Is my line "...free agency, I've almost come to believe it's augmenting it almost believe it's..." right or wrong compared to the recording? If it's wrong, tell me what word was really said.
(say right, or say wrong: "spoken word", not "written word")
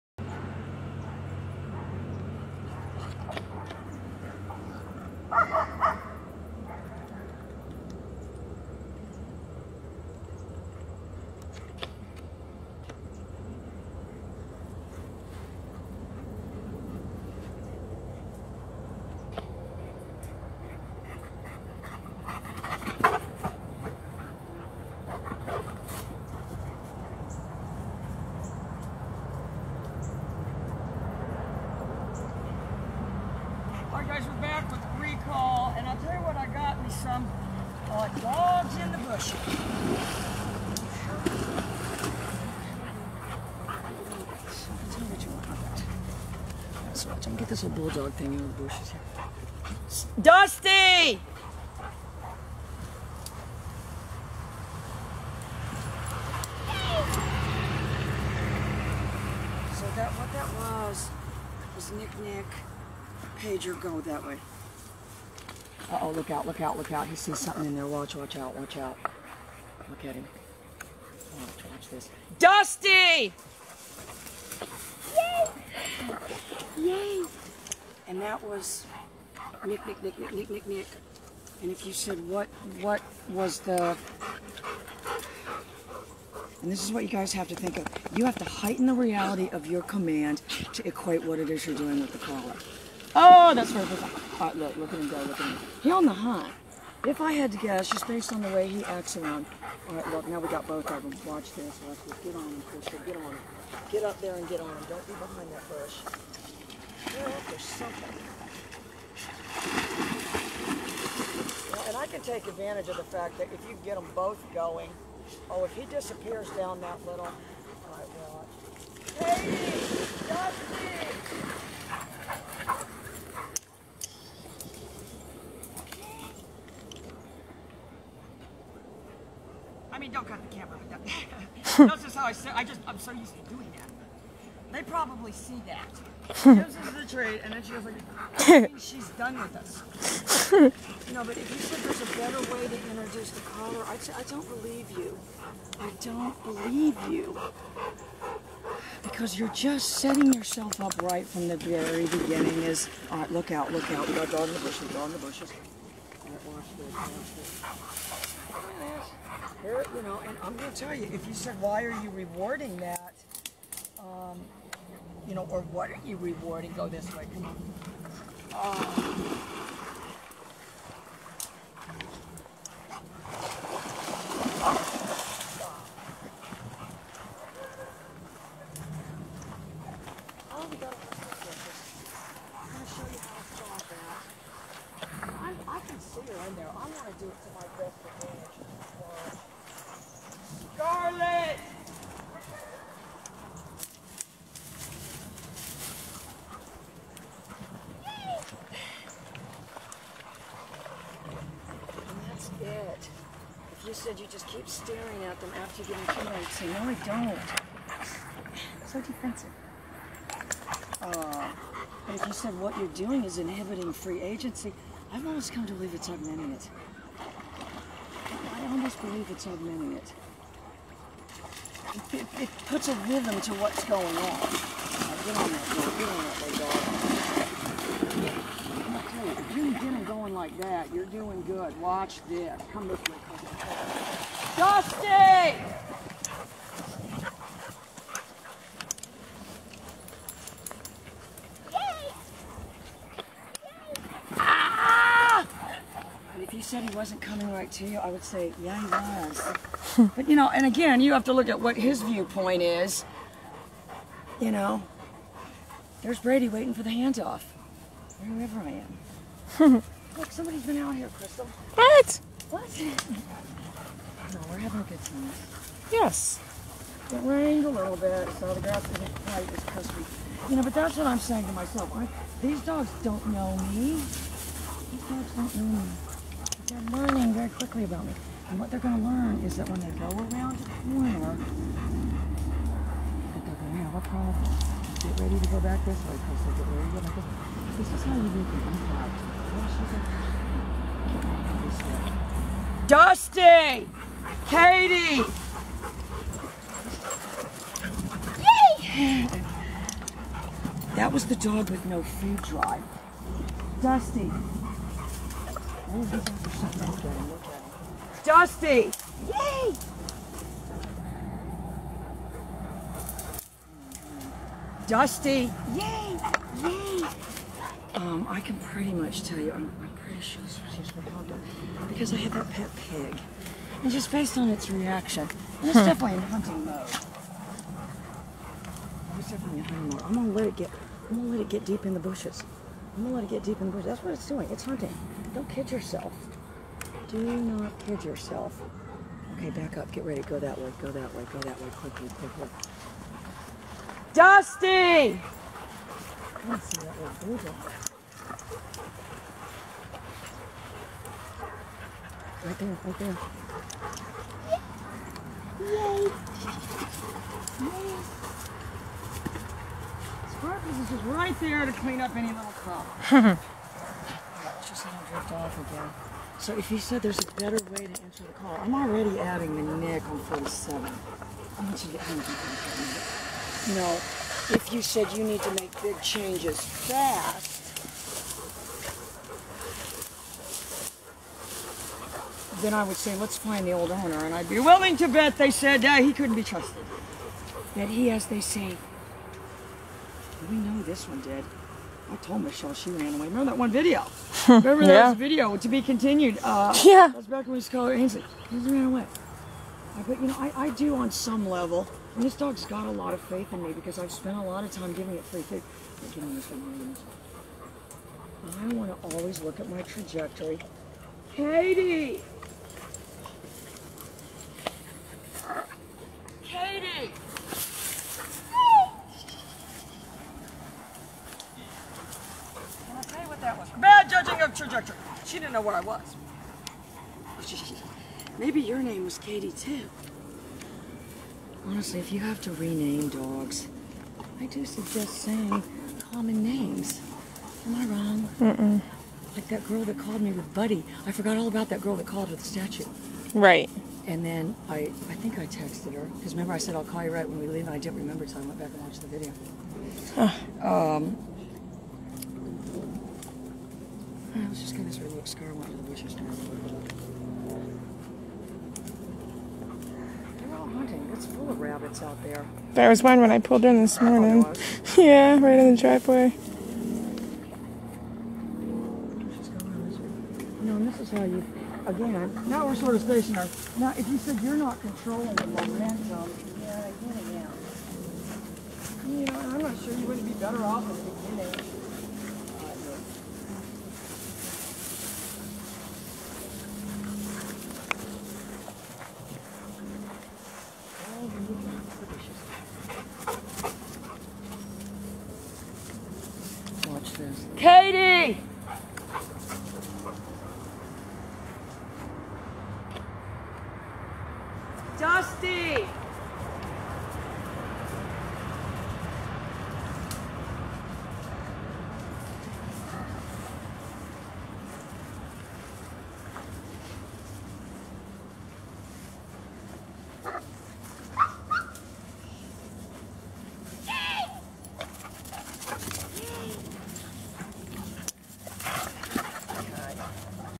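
right.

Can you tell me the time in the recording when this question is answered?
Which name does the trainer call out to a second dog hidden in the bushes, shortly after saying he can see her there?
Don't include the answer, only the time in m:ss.
3:10.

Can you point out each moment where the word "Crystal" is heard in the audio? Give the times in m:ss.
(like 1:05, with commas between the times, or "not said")
1:42, 4:21.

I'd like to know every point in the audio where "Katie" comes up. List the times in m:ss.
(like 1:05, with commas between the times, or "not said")
4:54, 6:51, 7:09.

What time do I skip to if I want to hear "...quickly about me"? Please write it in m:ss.
4:37.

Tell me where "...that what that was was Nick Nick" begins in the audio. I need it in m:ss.
0:59.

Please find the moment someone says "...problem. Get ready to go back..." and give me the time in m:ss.
4:44.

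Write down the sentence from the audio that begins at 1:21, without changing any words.
And if you said what, what was the...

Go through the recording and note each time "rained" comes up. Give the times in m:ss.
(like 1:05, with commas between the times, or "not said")
4:27.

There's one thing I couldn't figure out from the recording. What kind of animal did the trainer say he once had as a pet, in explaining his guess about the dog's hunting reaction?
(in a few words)
pig.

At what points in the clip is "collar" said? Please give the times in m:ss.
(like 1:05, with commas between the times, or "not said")
1:32, 2:23.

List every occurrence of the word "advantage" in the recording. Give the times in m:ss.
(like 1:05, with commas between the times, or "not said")
1:52, 3:08.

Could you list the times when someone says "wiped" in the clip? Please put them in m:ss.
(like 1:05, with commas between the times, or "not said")
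not said.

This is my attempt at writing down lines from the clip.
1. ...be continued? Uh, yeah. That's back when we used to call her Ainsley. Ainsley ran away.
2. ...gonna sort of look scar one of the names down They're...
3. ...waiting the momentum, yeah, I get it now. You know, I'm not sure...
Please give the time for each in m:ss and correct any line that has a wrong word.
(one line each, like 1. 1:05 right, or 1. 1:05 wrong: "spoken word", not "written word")
1. 6:35 right
2. 7:34 wrong: "bushes", not "names"
3. 7:54 wrong: "controlling", not "waiting".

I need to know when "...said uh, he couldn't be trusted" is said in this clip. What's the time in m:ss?
6:25.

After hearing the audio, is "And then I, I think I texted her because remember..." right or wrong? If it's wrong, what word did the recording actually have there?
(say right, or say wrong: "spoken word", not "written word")
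right.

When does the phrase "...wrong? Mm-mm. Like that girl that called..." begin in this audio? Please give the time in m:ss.
7:17.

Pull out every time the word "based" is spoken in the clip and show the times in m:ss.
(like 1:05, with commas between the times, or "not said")
1:38, 5:24.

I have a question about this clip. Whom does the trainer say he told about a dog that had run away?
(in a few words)
Michelle.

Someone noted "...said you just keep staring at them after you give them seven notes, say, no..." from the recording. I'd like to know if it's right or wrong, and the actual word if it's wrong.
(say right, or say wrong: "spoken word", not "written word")
wrong: "two", not "seven".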